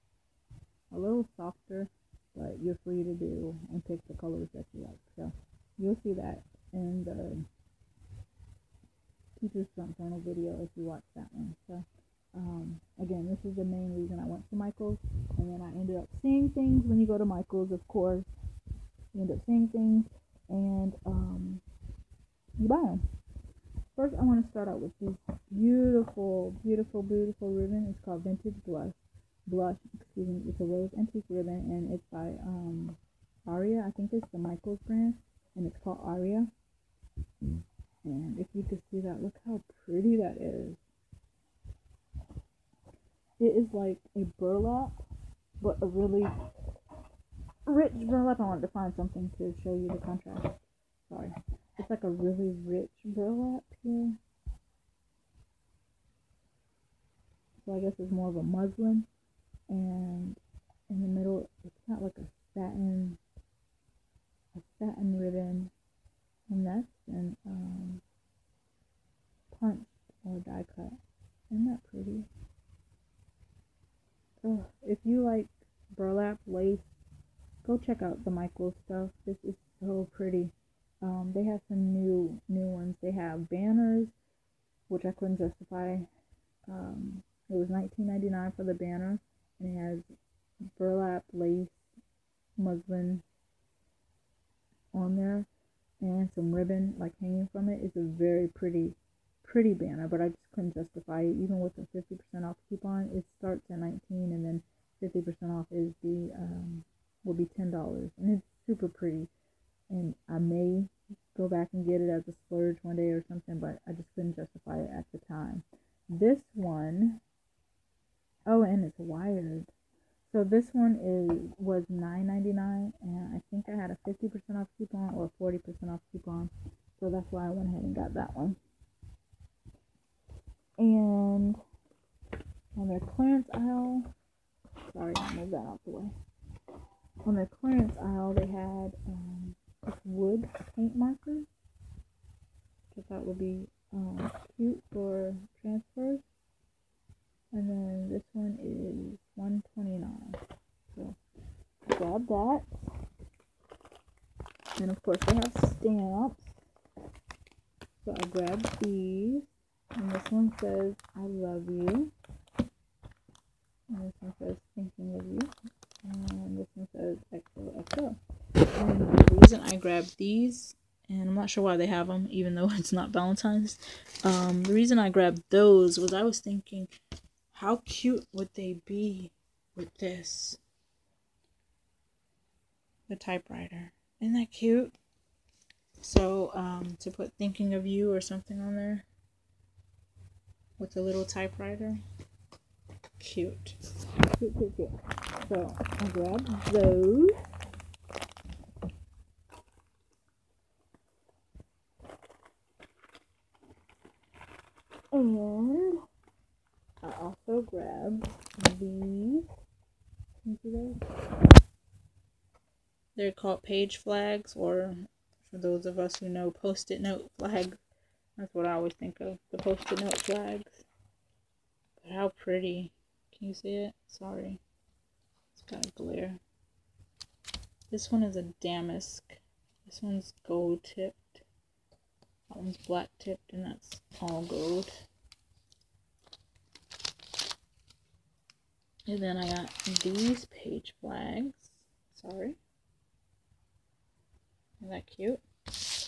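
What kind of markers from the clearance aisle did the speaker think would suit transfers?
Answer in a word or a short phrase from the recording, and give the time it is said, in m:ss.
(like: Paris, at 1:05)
wood paint markers, at 2:20.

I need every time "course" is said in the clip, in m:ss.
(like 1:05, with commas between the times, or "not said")
0:17, 2:35.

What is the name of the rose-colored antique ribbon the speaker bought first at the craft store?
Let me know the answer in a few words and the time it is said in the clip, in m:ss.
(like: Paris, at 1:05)
Vintage Blush, at 0:28.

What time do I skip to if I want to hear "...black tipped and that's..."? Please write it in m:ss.
3:52.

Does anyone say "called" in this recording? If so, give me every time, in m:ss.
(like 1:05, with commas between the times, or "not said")
0:28, 0:35, 3:33.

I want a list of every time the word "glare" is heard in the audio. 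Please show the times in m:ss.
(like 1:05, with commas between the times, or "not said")
3:45.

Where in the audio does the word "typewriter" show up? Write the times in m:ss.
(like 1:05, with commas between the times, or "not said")
3:03, 3:11.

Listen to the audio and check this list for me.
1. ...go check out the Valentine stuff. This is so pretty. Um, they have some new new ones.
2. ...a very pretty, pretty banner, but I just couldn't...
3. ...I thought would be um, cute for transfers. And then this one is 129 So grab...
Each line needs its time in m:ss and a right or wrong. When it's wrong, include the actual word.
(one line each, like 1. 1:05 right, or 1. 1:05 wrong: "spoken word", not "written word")
1. 1:17 wrong: "Michael", not "Valentine"
2. 1:37 right
3. 2:23 right.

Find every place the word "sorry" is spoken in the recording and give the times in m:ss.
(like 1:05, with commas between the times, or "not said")
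0:51, 2:14, 3:44, 4:02.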